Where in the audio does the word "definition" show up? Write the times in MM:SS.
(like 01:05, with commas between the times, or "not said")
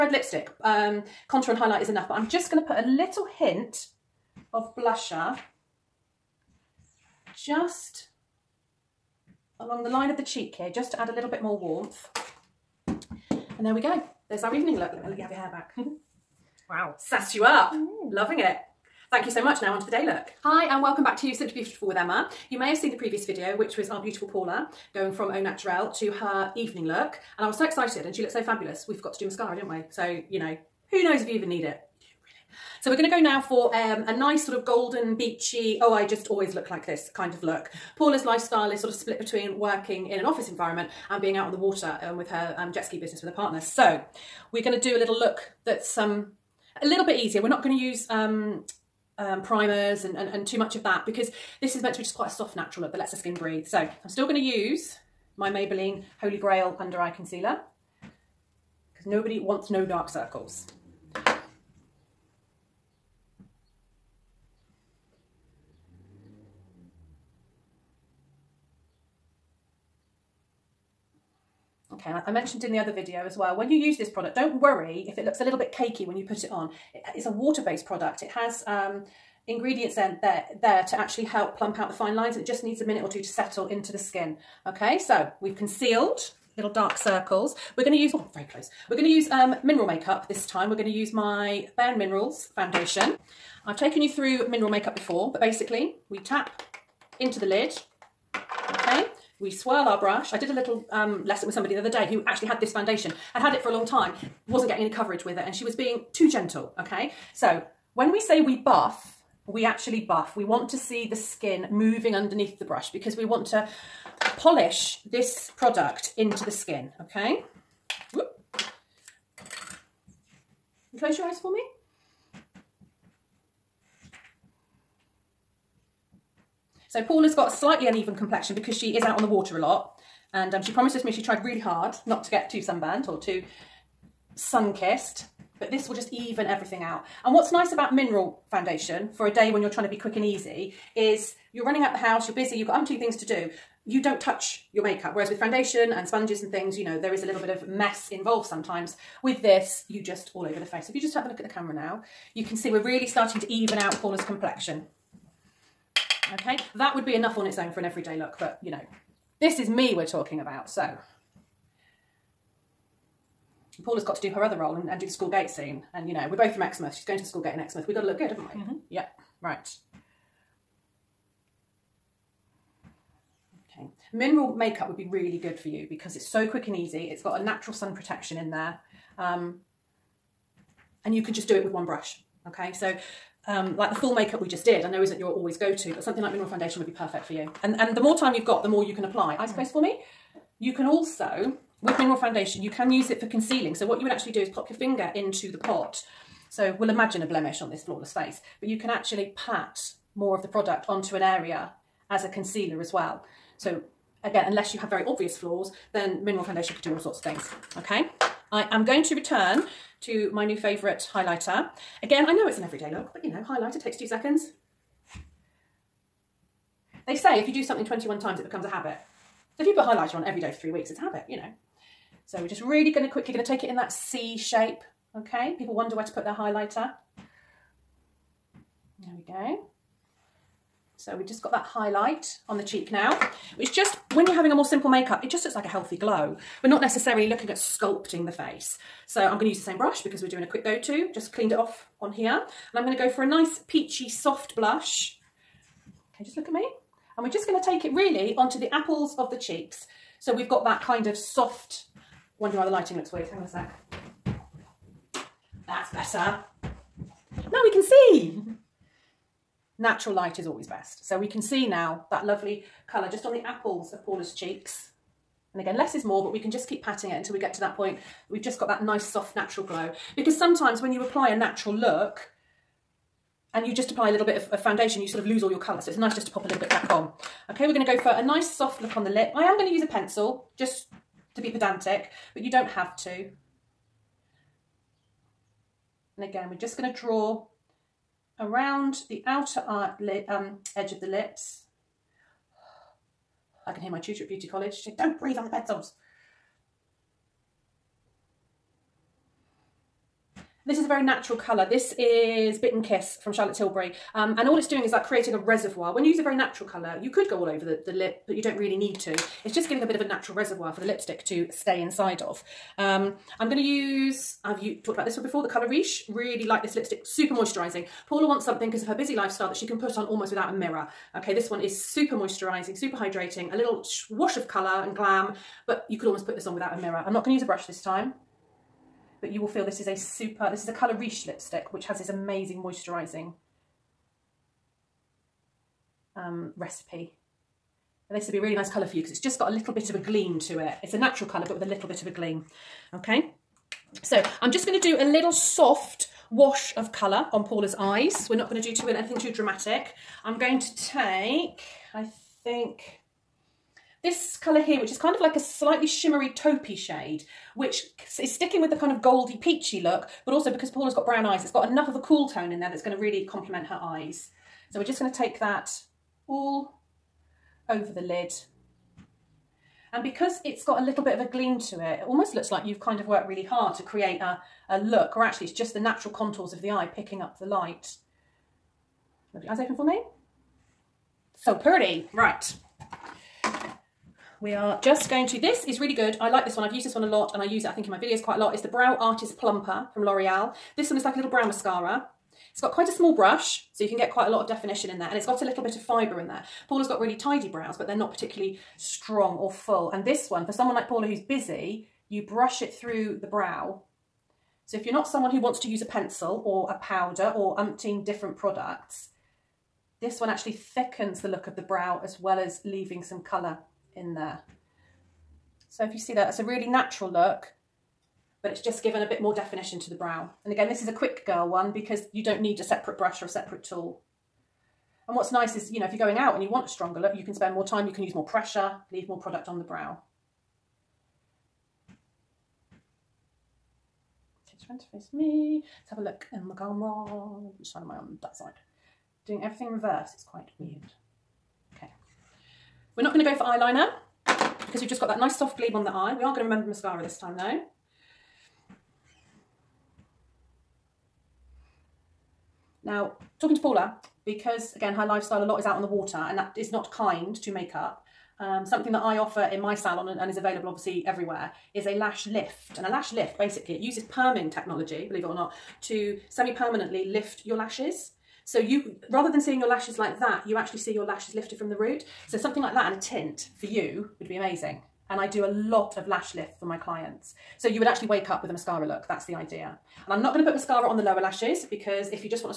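06:34, 06:59.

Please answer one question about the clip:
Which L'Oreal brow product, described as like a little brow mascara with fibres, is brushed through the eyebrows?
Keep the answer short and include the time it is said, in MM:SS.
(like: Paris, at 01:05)
Brow Artist Plumper, at 06:28.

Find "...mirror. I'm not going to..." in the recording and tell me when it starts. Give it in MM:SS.
05:26.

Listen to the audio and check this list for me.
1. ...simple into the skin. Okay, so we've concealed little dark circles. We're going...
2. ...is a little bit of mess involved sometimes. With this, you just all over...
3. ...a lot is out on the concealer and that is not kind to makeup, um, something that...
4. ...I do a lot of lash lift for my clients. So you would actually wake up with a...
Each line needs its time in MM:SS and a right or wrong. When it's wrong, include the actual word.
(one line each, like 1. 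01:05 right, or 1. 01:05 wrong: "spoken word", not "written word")
1. 01:23 wrong: "settle", not "simple"
2. 02:27 right
3. 07:35 wrong: "water", not "concealer"
4. 07:55 right.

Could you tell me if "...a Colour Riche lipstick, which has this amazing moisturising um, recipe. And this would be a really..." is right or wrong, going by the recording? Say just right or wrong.
right.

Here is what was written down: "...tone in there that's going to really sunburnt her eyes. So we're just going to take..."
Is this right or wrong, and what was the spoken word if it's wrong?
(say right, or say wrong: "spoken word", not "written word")
wrong: "complement", not "sunburnt".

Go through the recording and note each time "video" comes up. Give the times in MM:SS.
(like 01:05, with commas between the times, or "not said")
00:23, 01:12, 06:27.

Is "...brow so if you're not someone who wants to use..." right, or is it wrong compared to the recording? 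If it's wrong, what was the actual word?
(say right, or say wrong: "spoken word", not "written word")
right.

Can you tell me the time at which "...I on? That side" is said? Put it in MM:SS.
07:17.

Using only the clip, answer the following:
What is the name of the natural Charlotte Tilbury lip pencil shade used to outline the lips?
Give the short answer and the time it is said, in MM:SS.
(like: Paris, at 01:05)
Bitten Kiss, at 05:02.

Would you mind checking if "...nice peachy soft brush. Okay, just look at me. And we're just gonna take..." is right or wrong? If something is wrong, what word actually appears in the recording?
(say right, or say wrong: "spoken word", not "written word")
wrong: "blush", not "brush".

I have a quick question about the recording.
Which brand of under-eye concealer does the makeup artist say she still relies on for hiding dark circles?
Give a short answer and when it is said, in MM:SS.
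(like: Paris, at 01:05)
Maybelline, at 00:55.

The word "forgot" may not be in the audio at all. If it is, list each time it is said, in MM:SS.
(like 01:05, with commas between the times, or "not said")
00:28.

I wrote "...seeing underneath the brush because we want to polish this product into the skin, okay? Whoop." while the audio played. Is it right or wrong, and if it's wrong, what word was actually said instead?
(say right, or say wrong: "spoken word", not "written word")
wrong: "moving", not "seeing".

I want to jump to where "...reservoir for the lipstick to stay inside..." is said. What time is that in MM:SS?
05:10.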